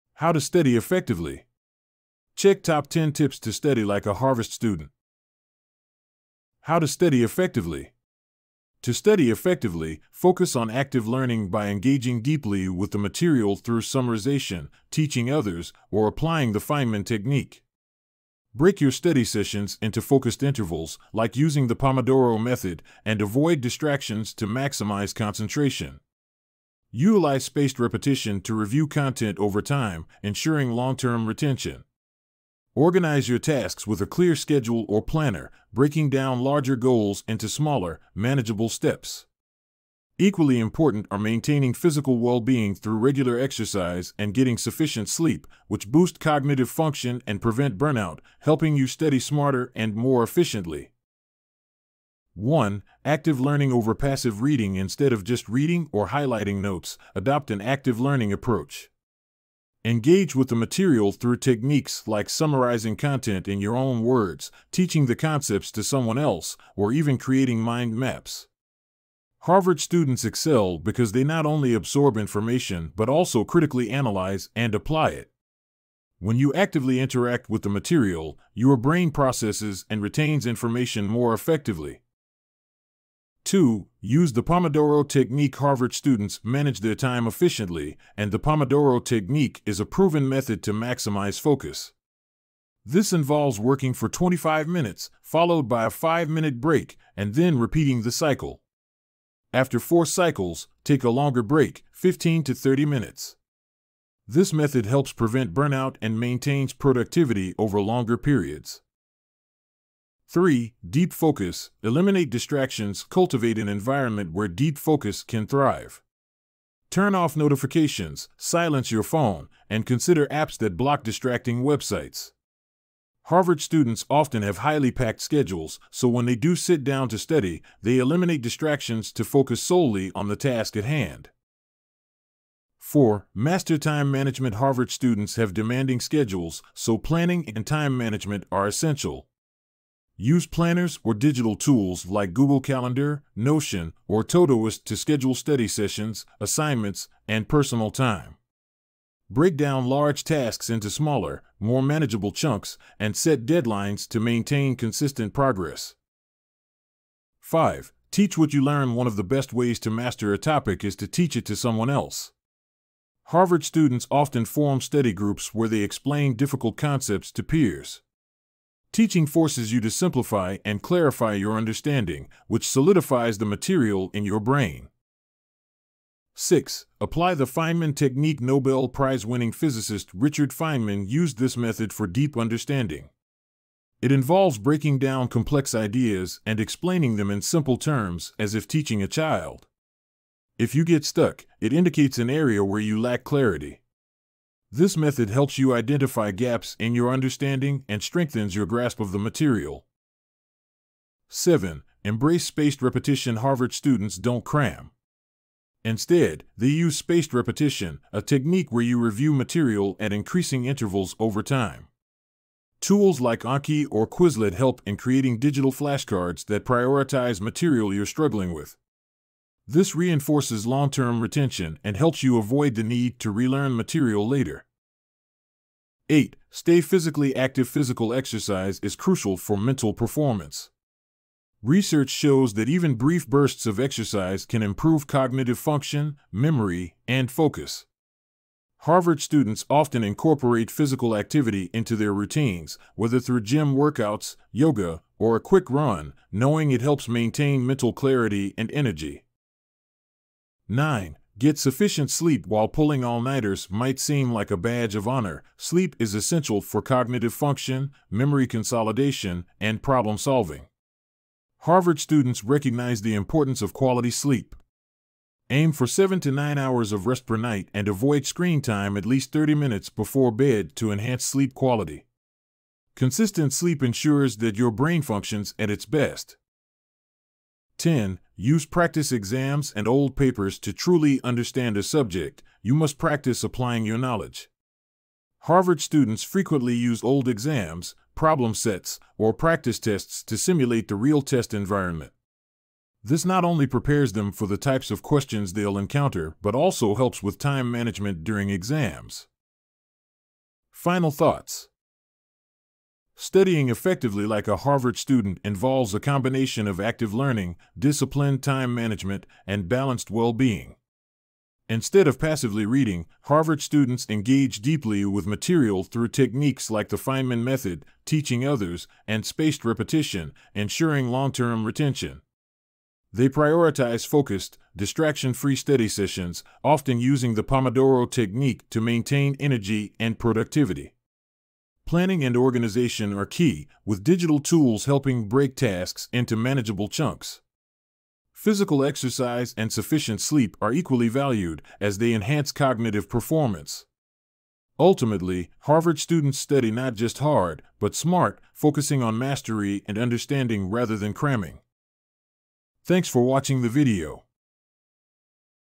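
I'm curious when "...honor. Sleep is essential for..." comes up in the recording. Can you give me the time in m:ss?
4:15.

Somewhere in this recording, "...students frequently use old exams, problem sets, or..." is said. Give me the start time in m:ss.
4:45.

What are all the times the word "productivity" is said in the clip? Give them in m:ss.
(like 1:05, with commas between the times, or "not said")
1:46, 5:30.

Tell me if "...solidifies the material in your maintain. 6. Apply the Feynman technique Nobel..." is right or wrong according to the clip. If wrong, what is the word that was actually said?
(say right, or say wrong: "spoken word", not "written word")
wrong: "brain", not "maintain".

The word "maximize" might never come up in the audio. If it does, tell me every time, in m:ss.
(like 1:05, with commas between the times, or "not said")
0:24, 1:30.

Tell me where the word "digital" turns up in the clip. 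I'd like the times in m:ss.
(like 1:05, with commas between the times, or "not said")
2:21, 3:35, 5:34.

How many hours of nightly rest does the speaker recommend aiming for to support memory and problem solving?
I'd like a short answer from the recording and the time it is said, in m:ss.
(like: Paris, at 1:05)
7 to 9 hours, at 4:25.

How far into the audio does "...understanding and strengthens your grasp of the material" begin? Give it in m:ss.
3:17.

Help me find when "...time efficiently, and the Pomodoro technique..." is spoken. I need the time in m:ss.
1:26.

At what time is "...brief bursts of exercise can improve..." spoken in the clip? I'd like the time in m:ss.
3:52.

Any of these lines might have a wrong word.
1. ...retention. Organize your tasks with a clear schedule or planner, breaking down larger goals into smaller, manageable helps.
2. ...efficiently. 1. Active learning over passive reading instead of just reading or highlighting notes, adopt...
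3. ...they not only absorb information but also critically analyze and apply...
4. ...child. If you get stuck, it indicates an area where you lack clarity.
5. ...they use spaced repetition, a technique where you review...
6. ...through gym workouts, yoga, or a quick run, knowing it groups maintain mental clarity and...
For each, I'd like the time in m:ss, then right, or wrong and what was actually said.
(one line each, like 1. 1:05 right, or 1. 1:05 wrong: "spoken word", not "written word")
1. 0:31 wrong: "steps", not "helps"
2. 0:50 right
3. 1:11 right
4. 3:09 right
5. 3:26 right
6. 4:03 wrong: "helps", not "groups".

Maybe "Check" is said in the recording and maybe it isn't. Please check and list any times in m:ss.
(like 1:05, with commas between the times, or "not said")
0:02.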